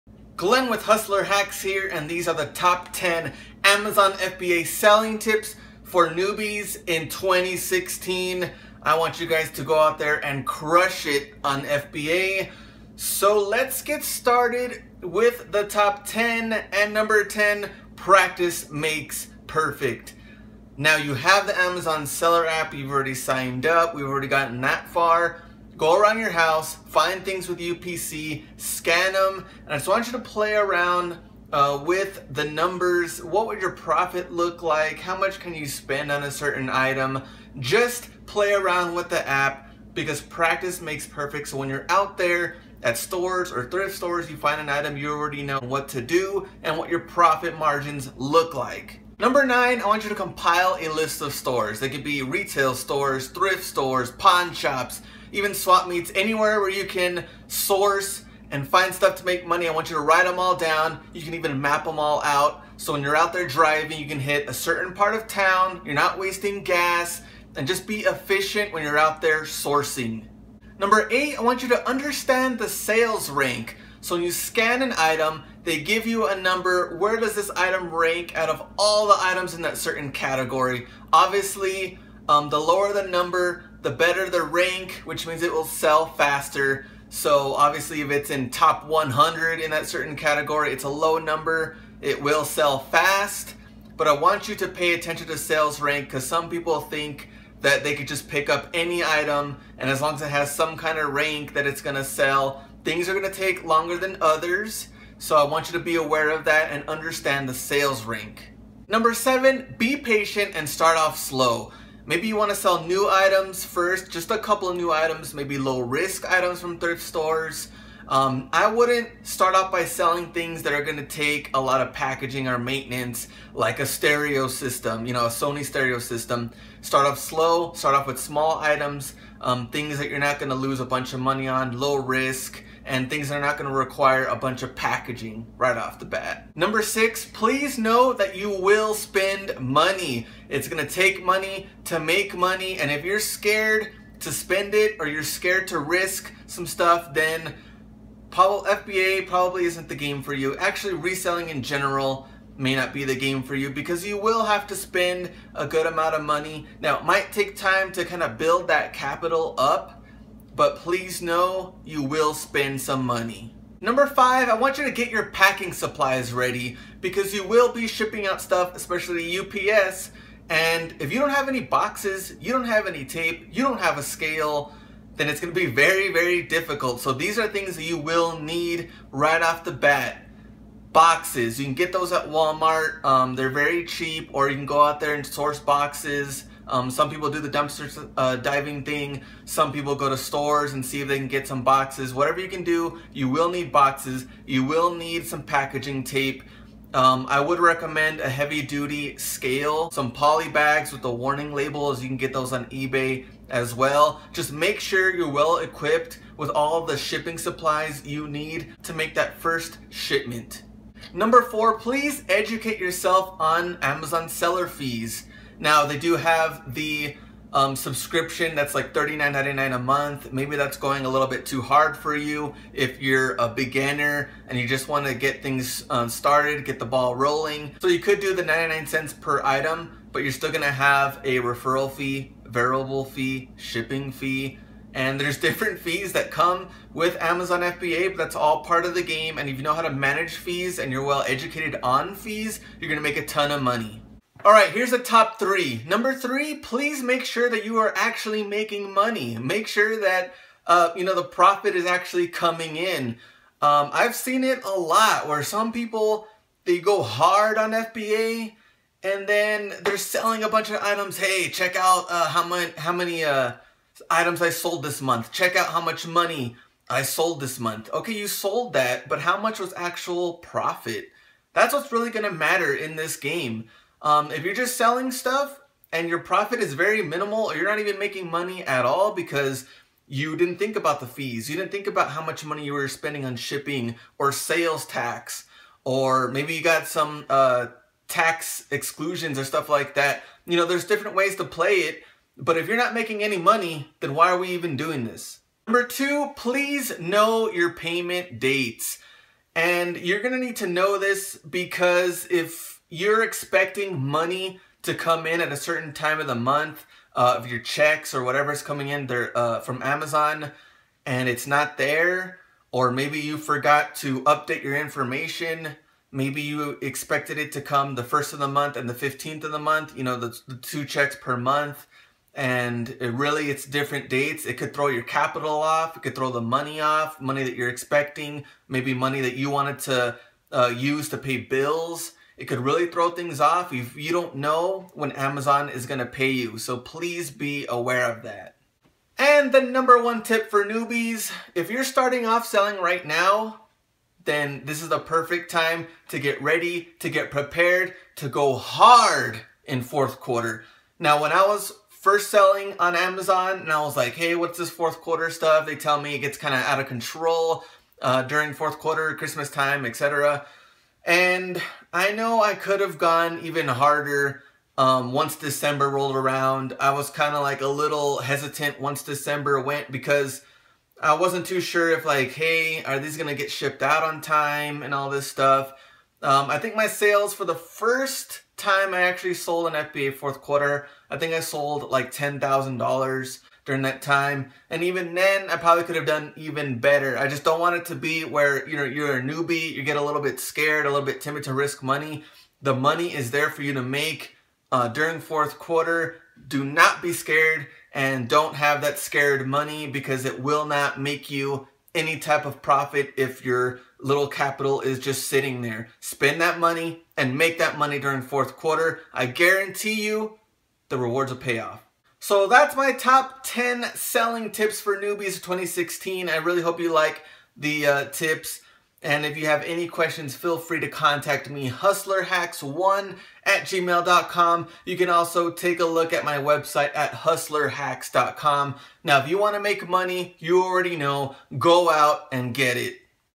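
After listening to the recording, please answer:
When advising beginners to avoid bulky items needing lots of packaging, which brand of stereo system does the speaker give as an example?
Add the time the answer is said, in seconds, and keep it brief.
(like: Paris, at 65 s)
Sony, at 125 s.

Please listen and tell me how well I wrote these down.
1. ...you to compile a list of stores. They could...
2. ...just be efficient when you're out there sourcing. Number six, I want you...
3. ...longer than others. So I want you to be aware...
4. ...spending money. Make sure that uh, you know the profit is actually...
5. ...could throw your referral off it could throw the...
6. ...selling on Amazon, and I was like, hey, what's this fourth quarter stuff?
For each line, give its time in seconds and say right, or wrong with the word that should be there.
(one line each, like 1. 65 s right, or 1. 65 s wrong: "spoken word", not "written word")
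1. 50 s right
2. 67 s wrong: "eight", not "six"
3. 103 s right
4. 248 s wrong: "making", not "spending"
5. 324 s wrong: "capital", not "referral"
6. 352 s right.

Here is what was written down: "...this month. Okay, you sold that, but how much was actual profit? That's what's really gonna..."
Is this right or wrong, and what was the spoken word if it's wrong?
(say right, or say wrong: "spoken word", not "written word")
right.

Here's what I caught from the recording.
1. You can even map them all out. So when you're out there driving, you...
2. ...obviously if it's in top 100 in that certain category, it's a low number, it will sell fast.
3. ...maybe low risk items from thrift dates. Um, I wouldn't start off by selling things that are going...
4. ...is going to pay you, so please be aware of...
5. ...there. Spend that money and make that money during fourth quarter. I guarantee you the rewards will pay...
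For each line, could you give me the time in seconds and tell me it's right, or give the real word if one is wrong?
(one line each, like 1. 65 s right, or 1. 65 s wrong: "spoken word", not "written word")
1. 61 s right
2. 87 s right
3. 115 s wrong: "stores", not "dates"
4. 335 s right
5. 405 s right.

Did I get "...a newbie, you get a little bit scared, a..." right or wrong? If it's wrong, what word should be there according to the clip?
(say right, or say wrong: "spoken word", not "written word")
right.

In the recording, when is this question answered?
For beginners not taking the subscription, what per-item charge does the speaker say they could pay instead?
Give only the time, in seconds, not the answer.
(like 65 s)
228 s.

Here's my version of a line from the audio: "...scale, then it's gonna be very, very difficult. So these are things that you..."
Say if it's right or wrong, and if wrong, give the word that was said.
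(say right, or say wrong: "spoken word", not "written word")
right.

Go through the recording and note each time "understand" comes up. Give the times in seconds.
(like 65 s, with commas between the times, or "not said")
71 s, 106 s.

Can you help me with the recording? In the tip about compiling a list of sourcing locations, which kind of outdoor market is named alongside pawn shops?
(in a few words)
Swap meets.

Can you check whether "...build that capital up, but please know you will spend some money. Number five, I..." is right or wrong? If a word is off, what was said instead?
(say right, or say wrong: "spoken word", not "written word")
right.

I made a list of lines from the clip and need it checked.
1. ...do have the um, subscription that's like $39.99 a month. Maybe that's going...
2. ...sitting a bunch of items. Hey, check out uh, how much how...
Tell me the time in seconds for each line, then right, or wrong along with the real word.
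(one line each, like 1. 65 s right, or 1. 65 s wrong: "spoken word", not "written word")
1. 215 s right
2. 259 s wrong: "selling", not "sitting".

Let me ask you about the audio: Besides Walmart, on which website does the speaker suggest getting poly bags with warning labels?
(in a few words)
eBay.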